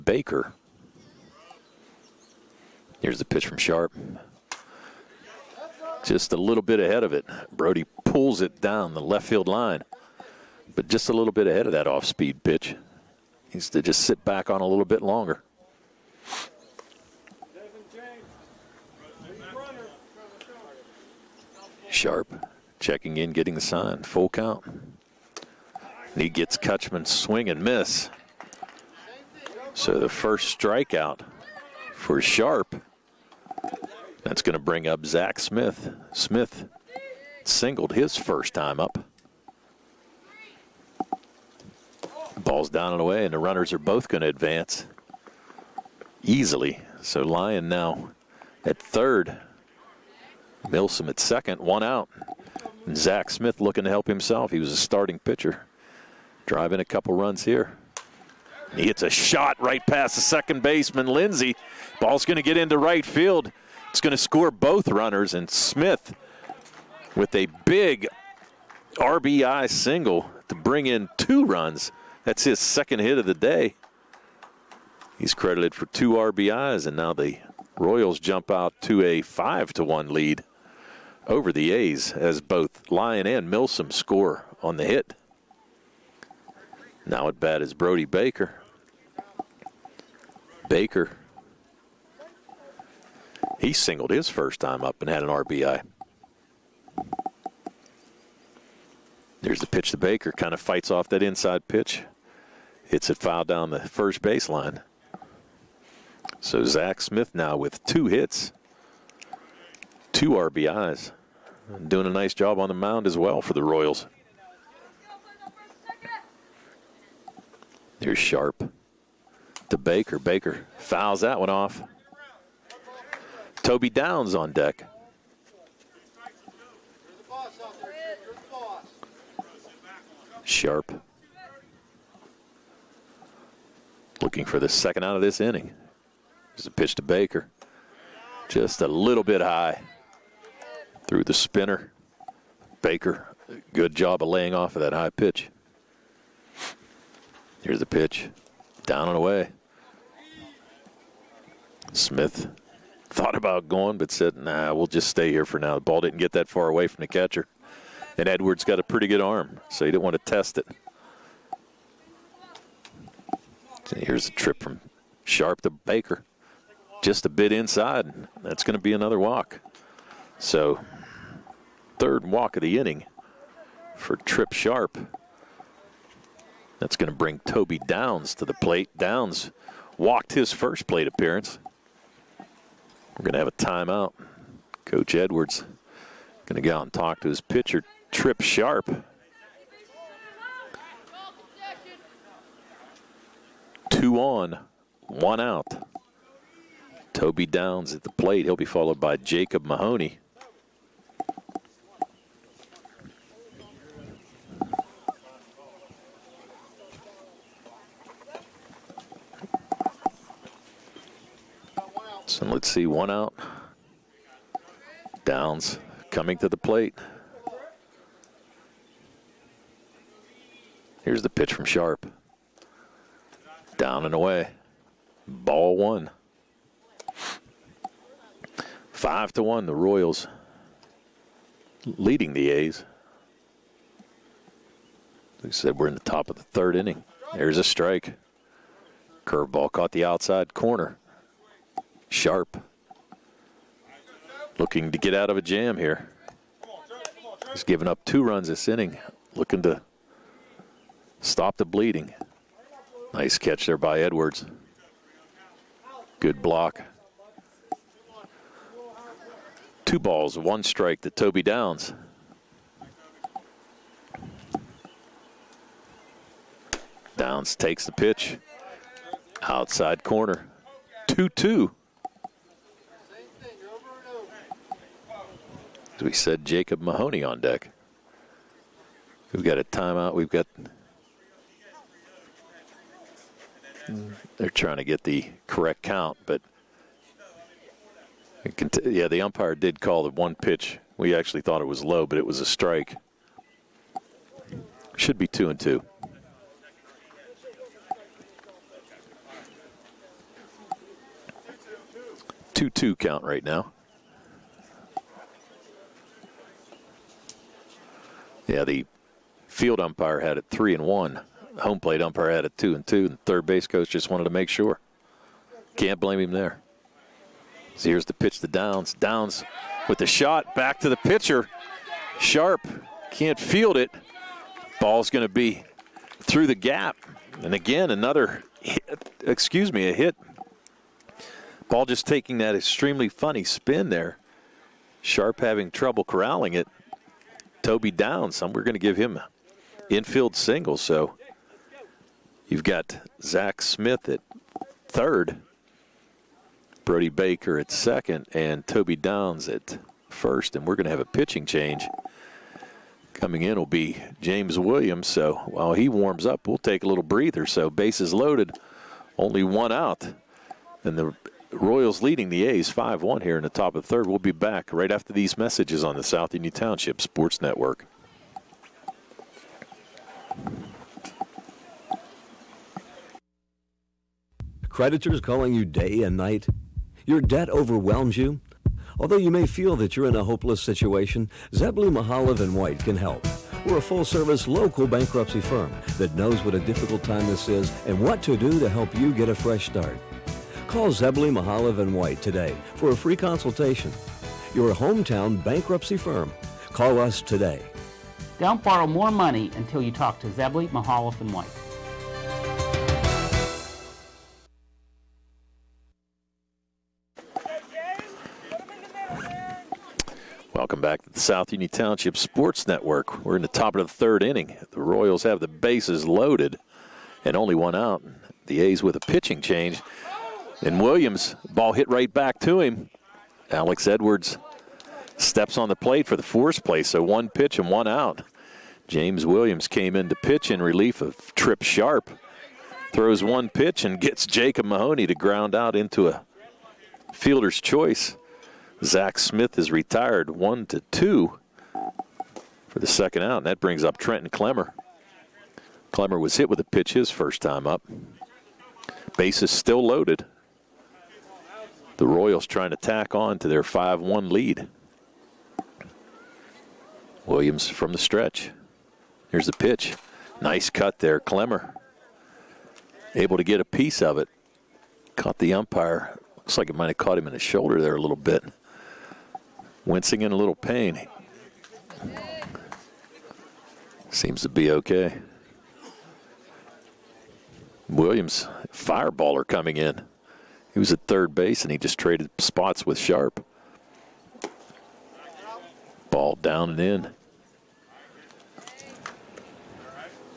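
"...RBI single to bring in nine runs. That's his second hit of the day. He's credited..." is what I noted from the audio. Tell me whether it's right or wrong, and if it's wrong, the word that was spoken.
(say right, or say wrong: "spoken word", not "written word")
wrong: "two", not "nine".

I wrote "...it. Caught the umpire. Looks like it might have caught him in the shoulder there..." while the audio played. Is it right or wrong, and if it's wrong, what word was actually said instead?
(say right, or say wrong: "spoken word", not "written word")
right.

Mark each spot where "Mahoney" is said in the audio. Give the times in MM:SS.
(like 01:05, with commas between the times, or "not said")
03:19, 04:36, 07:14.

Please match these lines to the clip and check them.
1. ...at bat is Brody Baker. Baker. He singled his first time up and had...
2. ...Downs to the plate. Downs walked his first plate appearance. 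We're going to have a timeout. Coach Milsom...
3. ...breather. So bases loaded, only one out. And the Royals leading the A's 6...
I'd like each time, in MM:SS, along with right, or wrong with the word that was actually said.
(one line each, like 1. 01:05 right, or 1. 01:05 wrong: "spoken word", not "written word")
1. 01:27 right
2. 02:57 wrong: "Edwards", not "Milsom"
3. 05:57 wrong: "5", not "6".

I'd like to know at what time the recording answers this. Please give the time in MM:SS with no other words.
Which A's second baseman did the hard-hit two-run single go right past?
01:01.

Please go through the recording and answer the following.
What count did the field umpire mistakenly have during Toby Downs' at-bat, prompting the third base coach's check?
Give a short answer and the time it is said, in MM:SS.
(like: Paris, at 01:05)
3 and 1, at 05:10.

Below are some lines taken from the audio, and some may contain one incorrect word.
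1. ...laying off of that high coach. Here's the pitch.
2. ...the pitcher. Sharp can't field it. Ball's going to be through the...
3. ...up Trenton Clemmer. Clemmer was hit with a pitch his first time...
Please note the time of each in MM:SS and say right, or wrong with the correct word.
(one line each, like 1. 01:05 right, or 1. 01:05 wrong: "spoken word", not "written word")
1. 02:24 wrong: "pitch", not "coach"
2. 05:20 right
3. 07:23 right.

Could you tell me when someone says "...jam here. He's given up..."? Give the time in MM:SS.
04:05.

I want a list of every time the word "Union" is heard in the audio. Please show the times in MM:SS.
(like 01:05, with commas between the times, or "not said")
06:06, 06:51.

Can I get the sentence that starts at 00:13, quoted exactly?
Needs to just sit back on a little bit longer.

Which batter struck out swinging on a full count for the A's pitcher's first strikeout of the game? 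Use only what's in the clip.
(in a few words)
Kutchman.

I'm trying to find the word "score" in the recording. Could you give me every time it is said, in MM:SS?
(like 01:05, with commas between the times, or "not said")
01:04, 01:23.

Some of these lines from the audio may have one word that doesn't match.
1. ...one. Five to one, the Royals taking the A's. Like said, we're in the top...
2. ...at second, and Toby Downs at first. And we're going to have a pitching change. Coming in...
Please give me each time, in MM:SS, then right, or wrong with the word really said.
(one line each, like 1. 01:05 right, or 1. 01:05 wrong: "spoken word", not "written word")
1. 03:45 wrong: "leading", not "taking"
2. 05:47 right.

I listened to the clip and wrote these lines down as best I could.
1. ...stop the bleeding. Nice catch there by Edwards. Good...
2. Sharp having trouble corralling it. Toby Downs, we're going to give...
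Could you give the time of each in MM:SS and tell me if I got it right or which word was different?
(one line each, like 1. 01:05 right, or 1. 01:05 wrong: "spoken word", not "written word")
1. 04:11 right
2. 05:35 right.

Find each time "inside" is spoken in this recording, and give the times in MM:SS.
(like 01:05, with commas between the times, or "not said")
01:41, 02:47.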